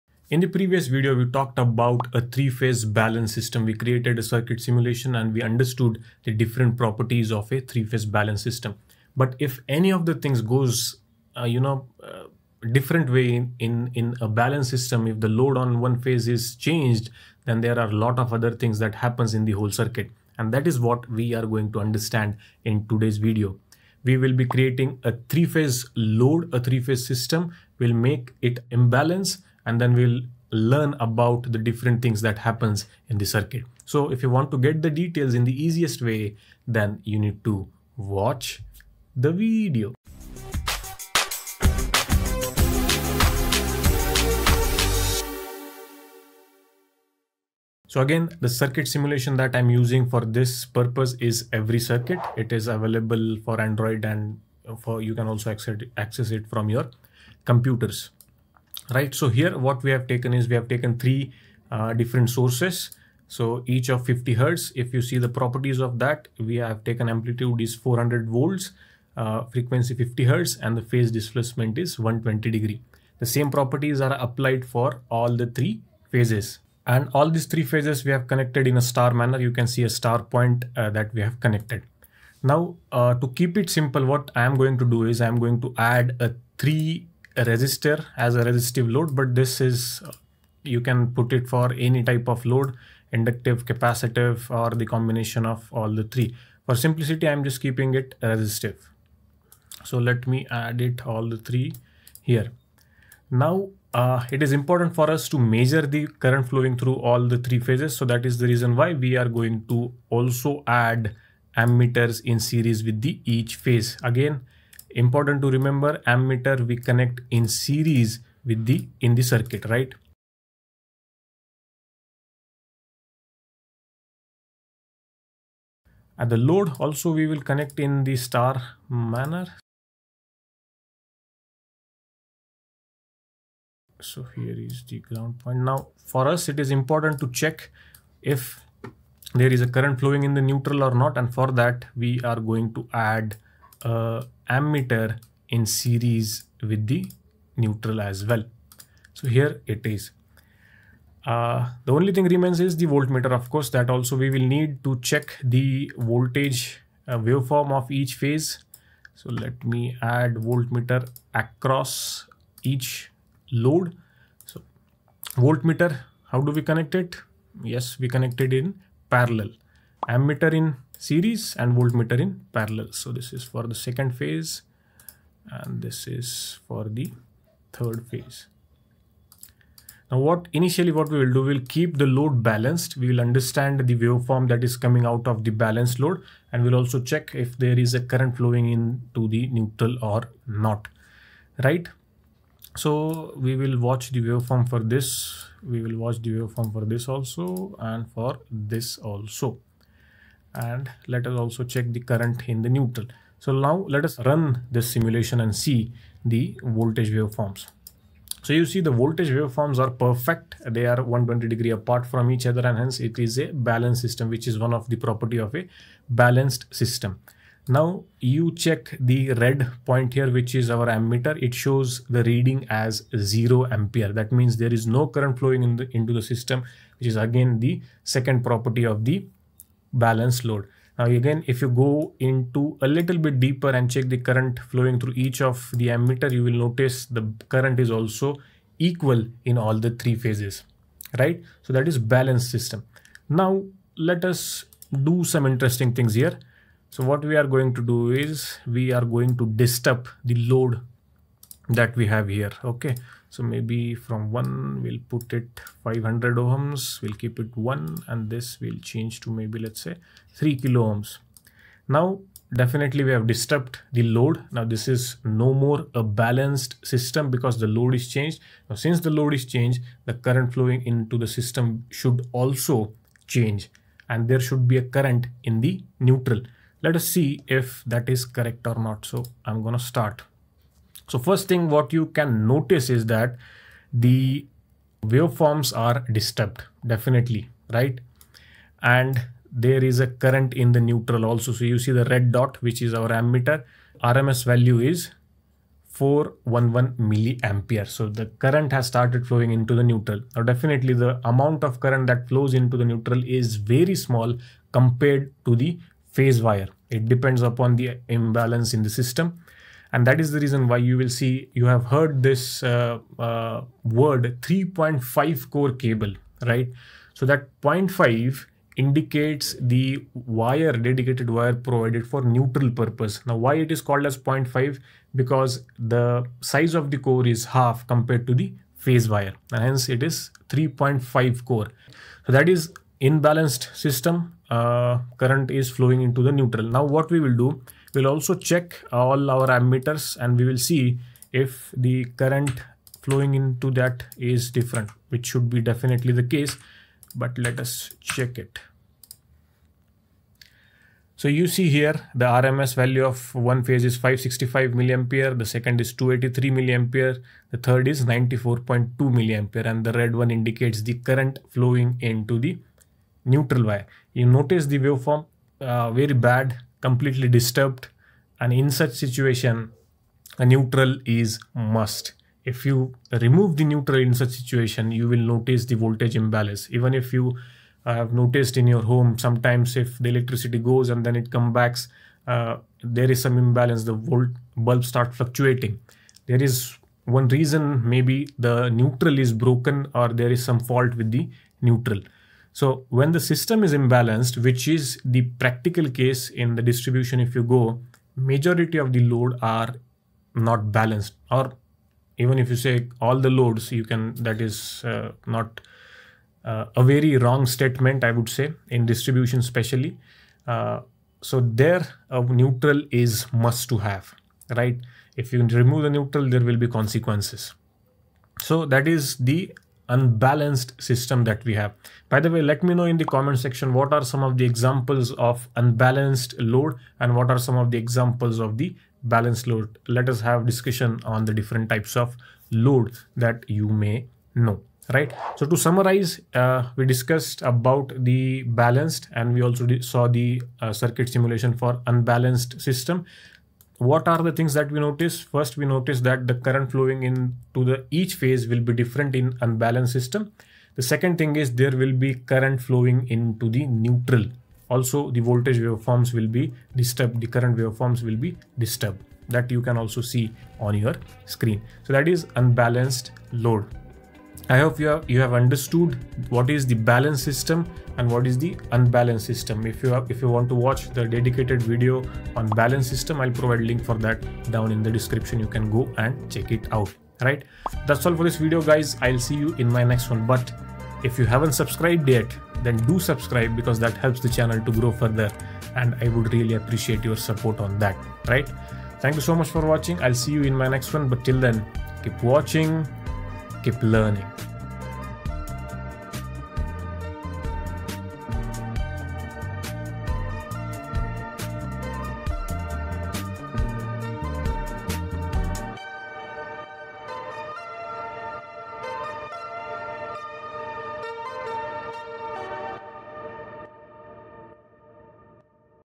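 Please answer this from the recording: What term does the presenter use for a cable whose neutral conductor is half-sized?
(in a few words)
3.5 core cable.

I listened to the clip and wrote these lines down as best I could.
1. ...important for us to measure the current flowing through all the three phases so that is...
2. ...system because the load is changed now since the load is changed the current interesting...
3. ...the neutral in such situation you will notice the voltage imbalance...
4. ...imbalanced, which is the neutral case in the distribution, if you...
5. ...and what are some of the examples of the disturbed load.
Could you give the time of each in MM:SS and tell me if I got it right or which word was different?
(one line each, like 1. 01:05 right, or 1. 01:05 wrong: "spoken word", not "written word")
1. 01:44 right
2. 04:26 wrong: "flowing", not "interesting"
3. 06:13 right
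4. 06:33 wrong: "practical", not "neutral"
5. 07:07 wrong: "balanced", not "disturbed".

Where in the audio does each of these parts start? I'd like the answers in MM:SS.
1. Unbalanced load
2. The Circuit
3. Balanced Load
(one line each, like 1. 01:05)
1. 04:02
2. 00:45
3. 03:00.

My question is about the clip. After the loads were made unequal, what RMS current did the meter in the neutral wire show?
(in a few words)
411 milliamperes.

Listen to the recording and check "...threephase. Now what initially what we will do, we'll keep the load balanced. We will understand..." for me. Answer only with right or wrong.
wrong.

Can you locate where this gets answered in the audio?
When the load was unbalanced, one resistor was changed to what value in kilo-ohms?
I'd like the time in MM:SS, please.
04:20.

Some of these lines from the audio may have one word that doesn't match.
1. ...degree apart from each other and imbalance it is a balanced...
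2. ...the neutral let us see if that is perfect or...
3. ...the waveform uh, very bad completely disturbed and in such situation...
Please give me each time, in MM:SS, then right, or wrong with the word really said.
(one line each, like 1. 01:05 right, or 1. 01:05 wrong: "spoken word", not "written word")
1. 03:31 wrong: "hence", not "imbalance"
2. 04:35 wrong: "correct", not "perfect"
3. 06:04 right.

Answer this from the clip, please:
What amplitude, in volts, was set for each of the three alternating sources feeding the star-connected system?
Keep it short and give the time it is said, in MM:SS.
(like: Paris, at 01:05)
400 volts, at 01:07.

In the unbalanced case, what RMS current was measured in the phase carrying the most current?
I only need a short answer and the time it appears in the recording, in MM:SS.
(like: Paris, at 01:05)
565 milliamperes, at 05:53.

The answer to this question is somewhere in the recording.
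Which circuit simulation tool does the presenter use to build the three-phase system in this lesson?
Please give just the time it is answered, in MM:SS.
00:51.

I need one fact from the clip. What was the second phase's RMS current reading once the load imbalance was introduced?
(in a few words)
283 milliamperes.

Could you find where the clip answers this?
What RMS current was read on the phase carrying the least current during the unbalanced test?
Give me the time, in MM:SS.
05:58.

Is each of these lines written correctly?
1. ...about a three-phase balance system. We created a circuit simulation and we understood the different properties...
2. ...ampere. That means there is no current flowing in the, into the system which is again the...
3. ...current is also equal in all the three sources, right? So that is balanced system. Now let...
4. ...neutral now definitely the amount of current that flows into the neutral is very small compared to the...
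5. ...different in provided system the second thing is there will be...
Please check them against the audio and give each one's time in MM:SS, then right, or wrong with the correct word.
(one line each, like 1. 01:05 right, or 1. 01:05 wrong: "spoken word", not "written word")
1. 00:01 right
2. 03:43 right
3. 03:57 wrong: "phases", not "sources"
4. 04:59 right
5. 07:28 wrong: "unbalanced", not "provided".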